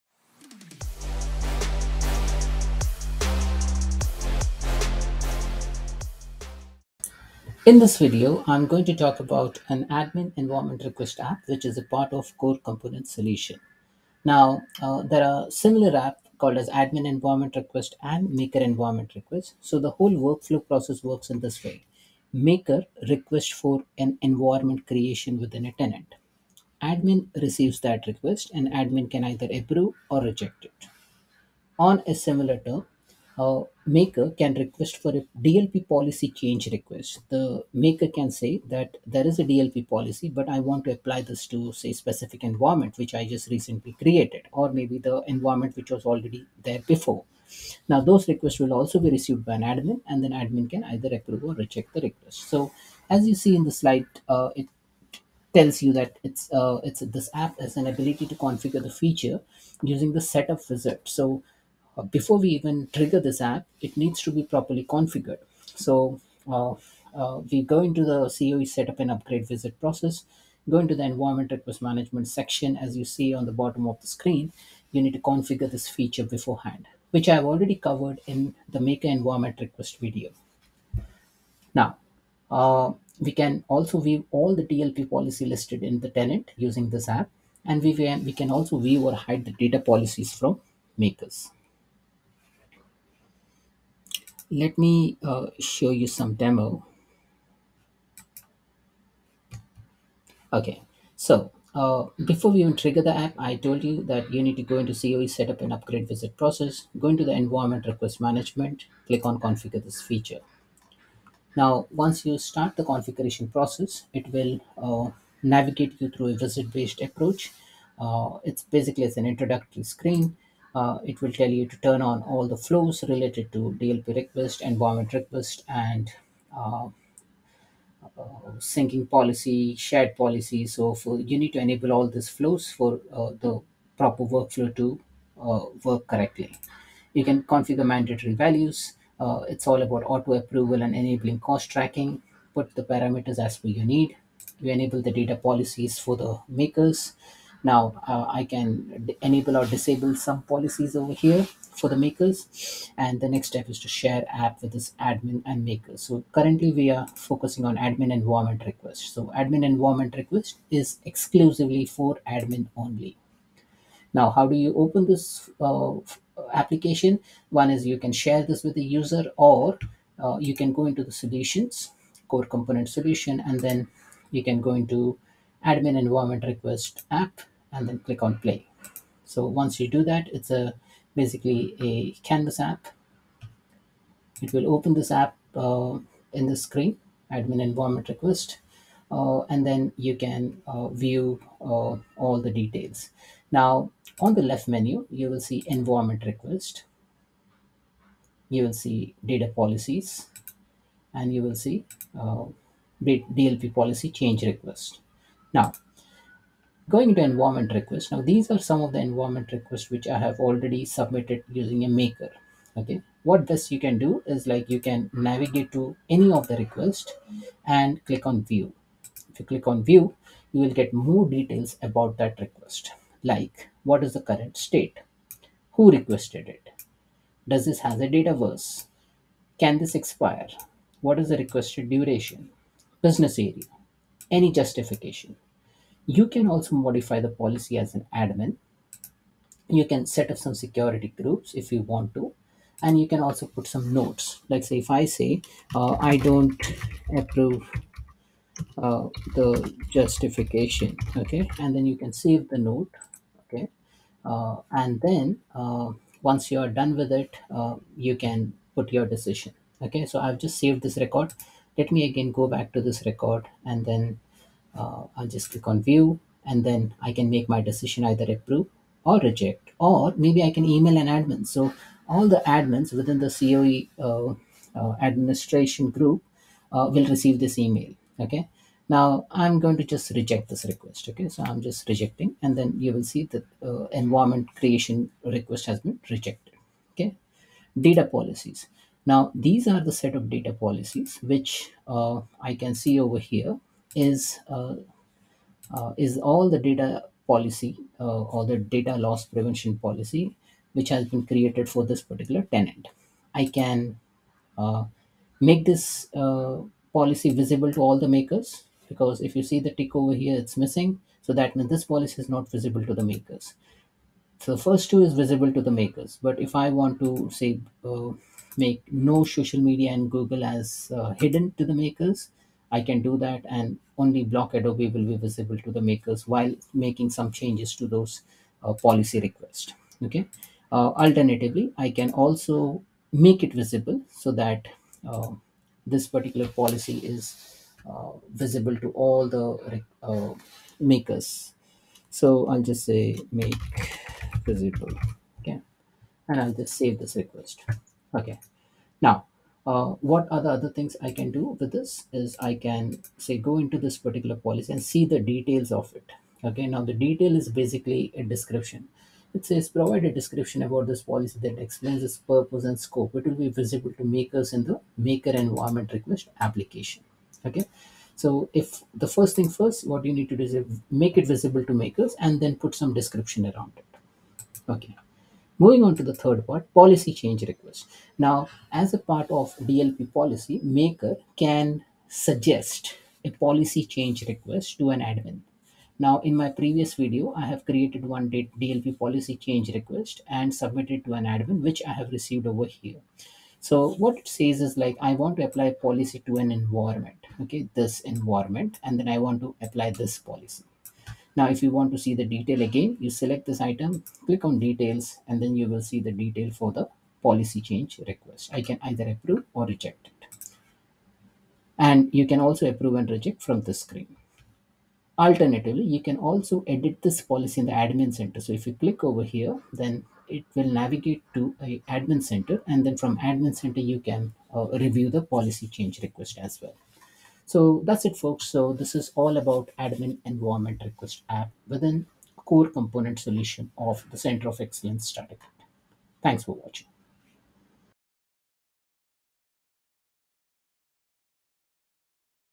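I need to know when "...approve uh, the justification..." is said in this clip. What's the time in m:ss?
4:07.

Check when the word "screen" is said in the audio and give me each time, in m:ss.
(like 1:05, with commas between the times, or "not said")
1:14, 1:59, 3:06, 6:53.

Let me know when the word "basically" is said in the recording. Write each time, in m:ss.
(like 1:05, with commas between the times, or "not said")
1:58, 3:01, 5:57.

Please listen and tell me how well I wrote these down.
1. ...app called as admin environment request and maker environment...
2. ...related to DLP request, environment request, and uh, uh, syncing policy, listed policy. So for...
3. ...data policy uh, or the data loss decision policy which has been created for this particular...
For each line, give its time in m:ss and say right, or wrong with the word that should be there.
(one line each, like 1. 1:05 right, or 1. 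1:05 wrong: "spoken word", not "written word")
1. 0:15 right
2. 2:03 wrong: "shared", not "listed"
3. 4:56 wrong: "prevention", not "decision".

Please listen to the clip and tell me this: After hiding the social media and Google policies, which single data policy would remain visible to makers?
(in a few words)
block Adobe.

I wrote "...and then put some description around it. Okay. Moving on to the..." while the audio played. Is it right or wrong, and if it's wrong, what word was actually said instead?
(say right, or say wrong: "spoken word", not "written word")
right.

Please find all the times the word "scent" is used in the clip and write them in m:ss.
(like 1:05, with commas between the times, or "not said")
not said.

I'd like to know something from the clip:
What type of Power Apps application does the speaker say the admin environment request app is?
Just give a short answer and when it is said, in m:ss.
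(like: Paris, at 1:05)
Canvas app, at 3:02.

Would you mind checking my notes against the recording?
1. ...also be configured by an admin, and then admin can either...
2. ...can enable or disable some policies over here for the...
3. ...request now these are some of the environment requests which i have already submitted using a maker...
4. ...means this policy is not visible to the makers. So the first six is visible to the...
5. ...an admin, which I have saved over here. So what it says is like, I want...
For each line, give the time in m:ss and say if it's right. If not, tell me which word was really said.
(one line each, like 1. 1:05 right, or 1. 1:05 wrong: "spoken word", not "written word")
1. 0:48 wrong: "received", not "configured"
2. 2:28 right
3. 3:27 right
4. 5:11 wrong: "two", not "six"
5. 6:31 wrong: "received", not "saved".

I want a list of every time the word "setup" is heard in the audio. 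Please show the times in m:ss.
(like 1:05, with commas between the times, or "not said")
1:00, 1:08, 1:45.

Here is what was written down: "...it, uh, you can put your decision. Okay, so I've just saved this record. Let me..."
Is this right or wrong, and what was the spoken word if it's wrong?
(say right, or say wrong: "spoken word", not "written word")
right.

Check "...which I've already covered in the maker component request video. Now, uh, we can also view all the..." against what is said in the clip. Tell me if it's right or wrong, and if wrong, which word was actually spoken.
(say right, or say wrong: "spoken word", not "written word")
wrong: "environment", not "component".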